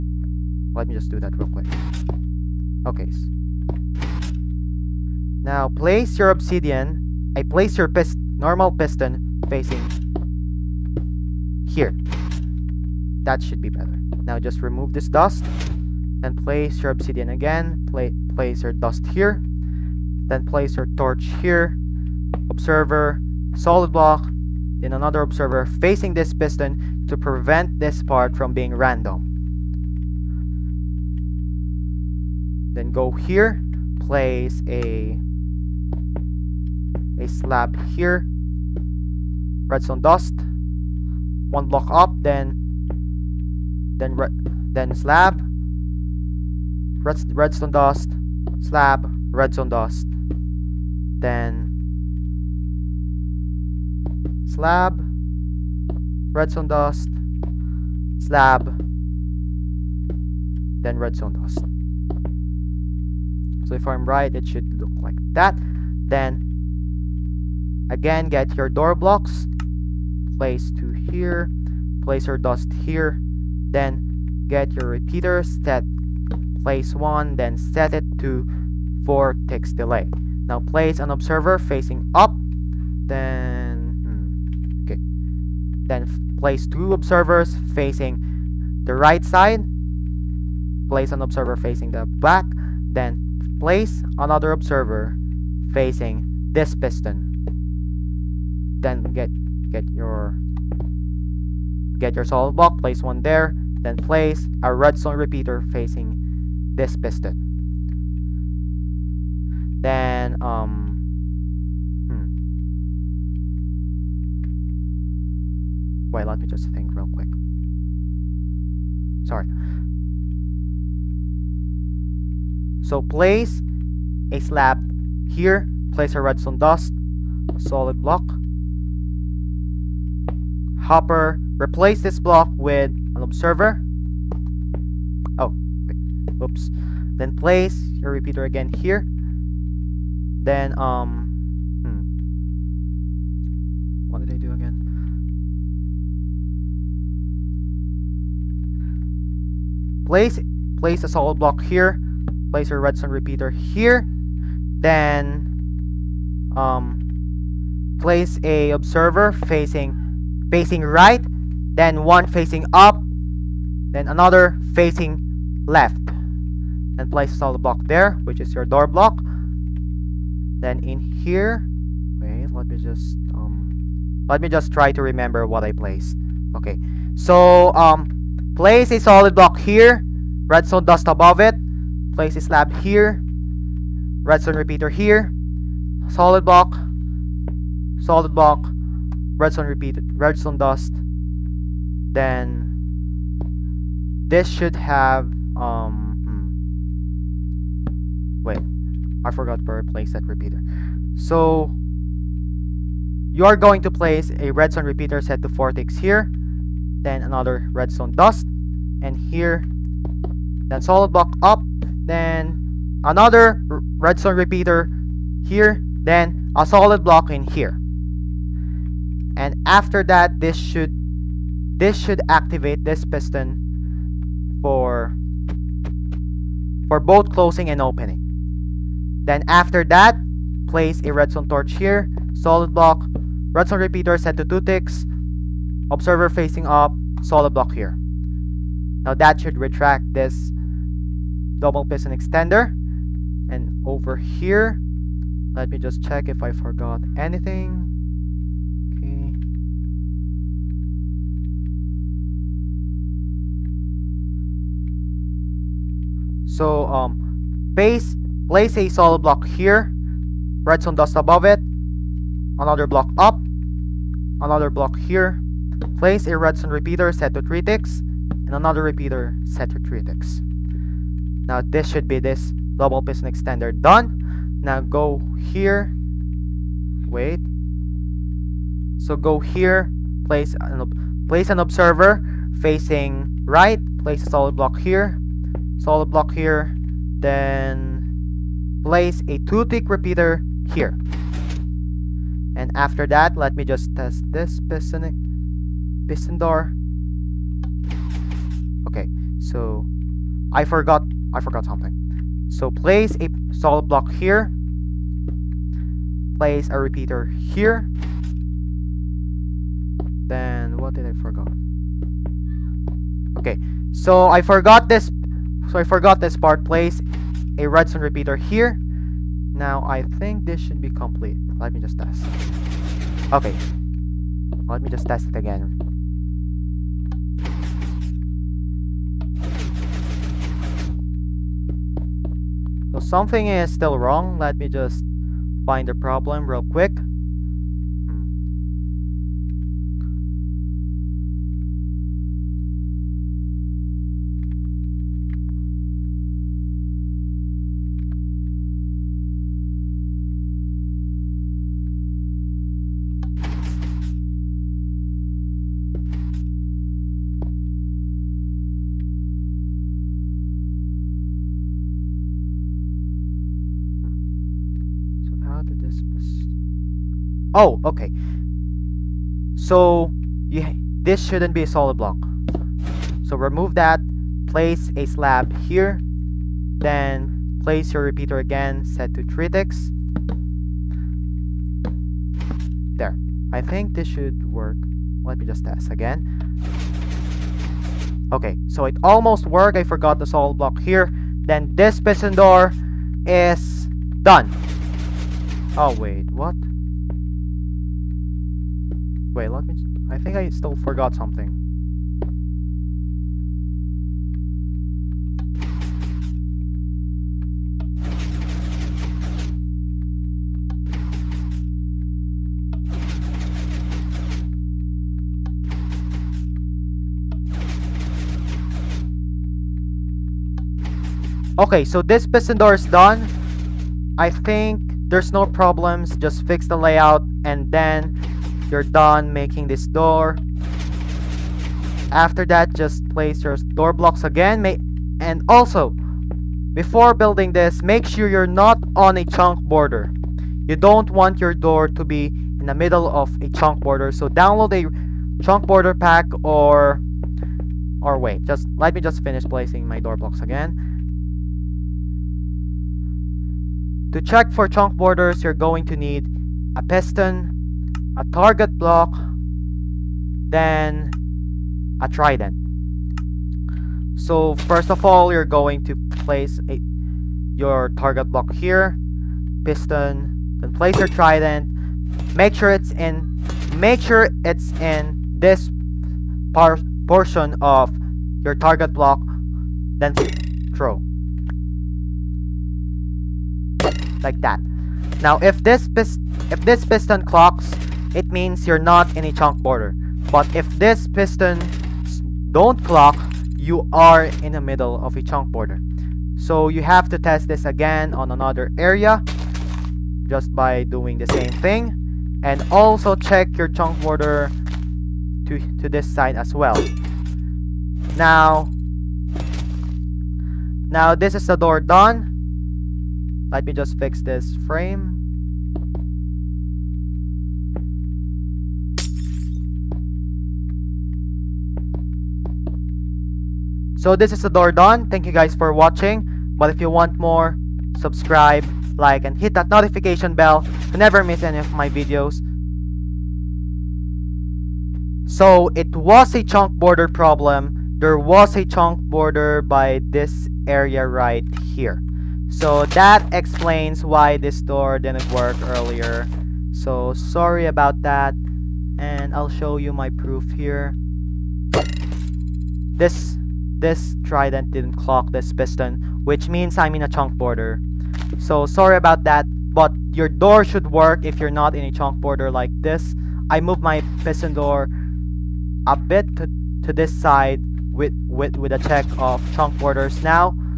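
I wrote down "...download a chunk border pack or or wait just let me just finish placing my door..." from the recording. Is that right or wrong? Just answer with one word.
right.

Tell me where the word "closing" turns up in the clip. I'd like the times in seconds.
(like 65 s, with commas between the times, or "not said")
227 s.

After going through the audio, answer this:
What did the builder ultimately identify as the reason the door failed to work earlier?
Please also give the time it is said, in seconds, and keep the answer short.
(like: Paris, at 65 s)
Chunk border problem, at 536 s.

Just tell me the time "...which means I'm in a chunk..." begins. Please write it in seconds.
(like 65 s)
556 s.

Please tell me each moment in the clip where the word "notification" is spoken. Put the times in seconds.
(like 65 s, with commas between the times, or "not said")
529 s.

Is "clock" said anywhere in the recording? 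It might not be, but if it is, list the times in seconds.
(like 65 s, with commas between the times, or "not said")
487 s, 492 s, 554 s.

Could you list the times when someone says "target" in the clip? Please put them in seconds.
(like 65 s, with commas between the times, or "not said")
458 s, 467 s, 478 s.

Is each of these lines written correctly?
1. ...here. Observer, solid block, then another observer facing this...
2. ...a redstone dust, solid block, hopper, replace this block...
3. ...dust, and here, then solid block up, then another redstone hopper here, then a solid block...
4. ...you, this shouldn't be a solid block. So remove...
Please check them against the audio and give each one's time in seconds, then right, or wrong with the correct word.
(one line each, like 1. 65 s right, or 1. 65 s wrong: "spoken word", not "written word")
1. 21 s right
2. 126 s right
3. 208 s wrong: "repeater", not "hopper"
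4. 370 s right.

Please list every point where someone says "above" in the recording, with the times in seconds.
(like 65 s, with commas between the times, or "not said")
181 s, 261 s.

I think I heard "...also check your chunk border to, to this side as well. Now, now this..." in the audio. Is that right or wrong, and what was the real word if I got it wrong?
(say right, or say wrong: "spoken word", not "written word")
right.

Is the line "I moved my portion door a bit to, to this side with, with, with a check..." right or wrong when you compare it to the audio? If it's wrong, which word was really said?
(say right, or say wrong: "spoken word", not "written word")
wrong: "piston", not "portion".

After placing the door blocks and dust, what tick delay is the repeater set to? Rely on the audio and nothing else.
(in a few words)
4 ticks.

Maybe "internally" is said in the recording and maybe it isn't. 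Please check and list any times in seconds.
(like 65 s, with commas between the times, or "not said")
not said.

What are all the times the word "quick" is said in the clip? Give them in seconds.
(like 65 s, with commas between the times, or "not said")
1 s, 117 s, 336 s.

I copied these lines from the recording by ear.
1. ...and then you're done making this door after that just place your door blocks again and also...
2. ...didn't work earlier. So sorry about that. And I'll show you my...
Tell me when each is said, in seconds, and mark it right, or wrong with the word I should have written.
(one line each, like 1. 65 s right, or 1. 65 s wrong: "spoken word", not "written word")
1. 427 s right
2. 544 s right.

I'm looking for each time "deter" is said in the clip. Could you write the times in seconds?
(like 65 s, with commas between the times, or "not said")
not said.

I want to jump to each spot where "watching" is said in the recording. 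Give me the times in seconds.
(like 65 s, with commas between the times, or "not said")
525 s.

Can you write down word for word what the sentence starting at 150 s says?
Place, place a solid block here.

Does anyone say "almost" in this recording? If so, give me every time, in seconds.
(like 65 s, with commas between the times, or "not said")
389 s.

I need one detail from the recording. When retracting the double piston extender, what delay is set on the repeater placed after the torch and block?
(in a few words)
2 ticks.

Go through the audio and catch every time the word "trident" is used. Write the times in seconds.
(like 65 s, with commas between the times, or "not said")
462 s, 471 s, 554 s.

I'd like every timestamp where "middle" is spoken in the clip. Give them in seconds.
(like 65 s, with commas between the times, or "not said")
442 s, 494 s.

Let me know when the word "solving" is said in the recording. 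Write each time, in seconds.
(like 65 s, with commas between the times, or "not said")
not said.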